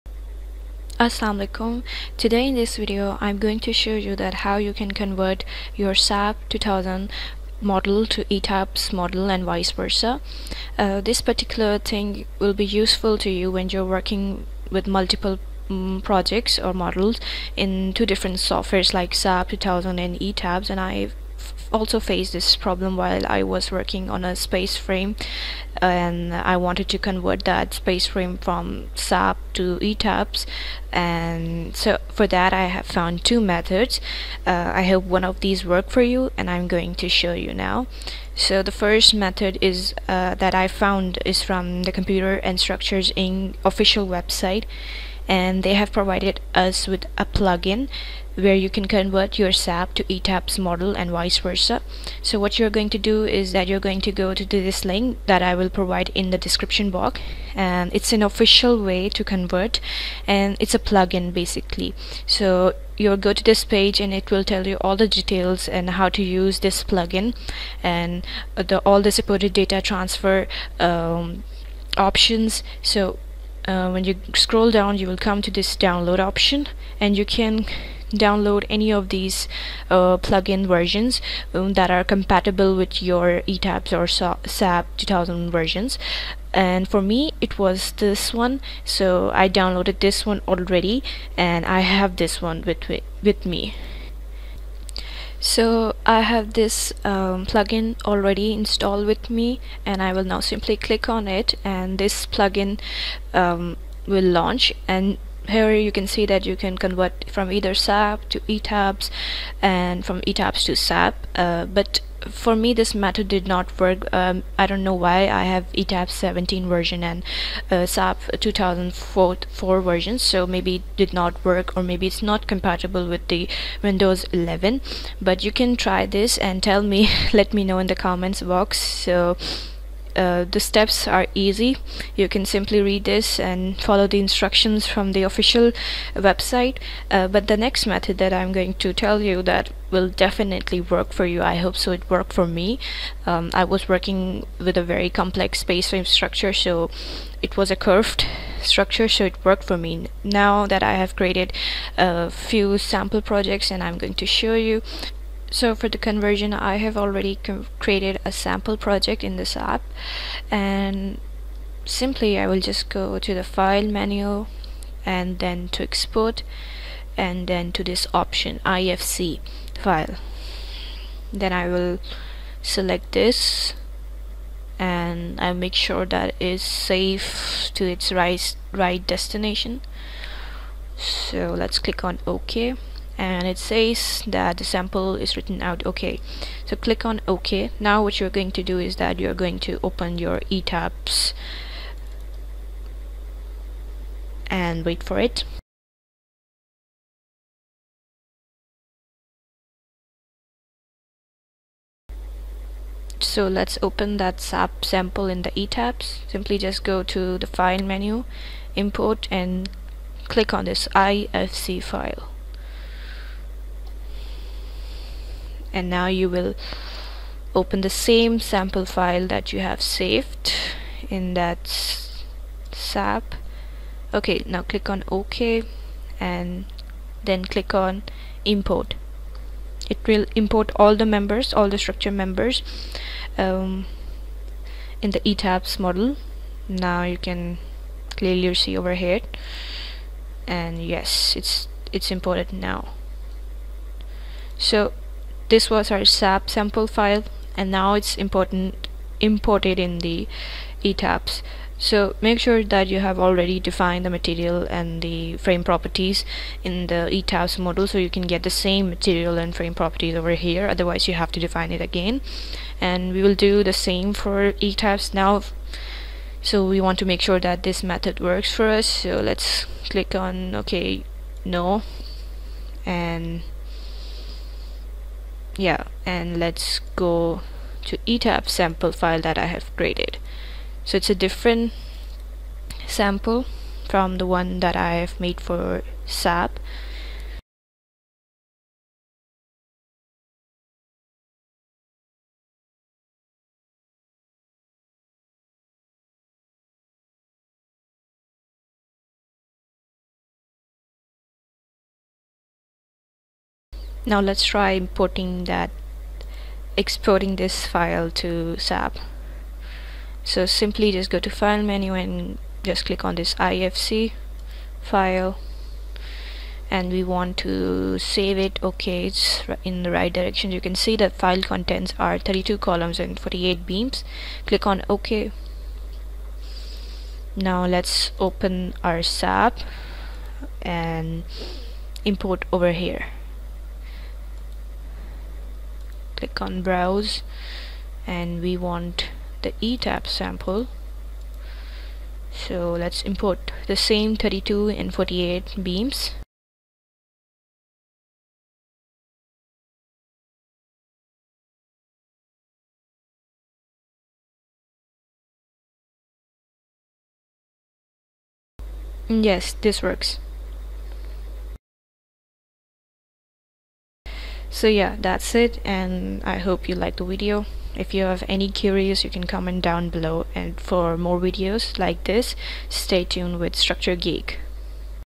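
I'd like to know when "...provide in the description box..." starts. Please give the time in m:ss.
0:55.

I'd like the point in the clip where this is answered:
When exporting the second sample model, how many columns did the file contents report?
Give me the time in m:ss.
5:22.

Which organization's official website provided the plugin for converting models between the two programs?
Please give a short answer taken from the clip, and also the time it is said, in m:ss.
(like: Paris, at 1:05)
Computer and Structures Inc, at 0:41.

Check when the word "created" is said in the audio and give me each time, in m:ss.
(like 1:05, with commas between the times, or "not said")
2:31, 2:37, 4:39.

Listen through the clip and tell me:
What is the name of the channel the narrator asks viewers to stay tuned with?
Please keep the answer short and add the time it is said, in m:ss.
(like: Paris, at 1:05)
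Structure Geek, at 6:13.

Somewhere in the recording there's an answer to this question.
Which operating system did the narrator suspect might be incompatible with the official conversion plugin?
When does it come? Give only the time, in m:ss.
2:03.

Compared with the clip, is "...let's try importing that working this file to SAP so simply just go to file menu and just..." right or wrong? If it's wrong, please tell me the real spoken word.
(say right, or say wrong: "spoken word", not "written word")
wrong: "exporting", not "working".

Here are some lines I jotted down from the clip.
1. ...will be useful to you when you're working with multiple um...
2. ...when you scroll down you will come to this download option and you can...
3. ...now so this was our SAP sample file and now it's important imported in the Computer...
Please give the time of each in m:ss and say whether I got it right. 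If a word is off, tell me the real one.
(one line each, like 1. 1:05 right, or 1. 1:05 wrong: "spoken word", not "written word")
1. 0:12 right
2. 1:13 right
3. 4:02 wrong: "ETABS", not "Computer".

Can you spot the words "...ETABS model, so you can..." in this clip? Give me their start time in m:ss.
4:17.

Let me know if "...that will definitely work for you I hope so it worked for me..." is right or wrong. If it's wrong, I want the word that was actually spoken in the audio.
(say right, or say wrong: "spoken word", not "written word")
right.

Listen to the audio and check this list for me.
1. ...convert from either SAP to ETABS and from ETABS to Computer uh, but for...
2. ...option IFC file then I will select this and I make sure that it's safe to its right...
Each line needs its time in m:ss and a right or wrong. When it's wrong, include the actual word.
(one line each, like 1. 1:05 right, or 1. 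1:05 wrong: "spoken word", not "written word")
1. 1:46 wrong: "SAP", not "Computer"
2. 2:48 right.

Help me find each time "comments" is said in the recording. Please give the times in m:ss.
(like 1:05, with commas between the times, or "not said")
2:07, 6:09.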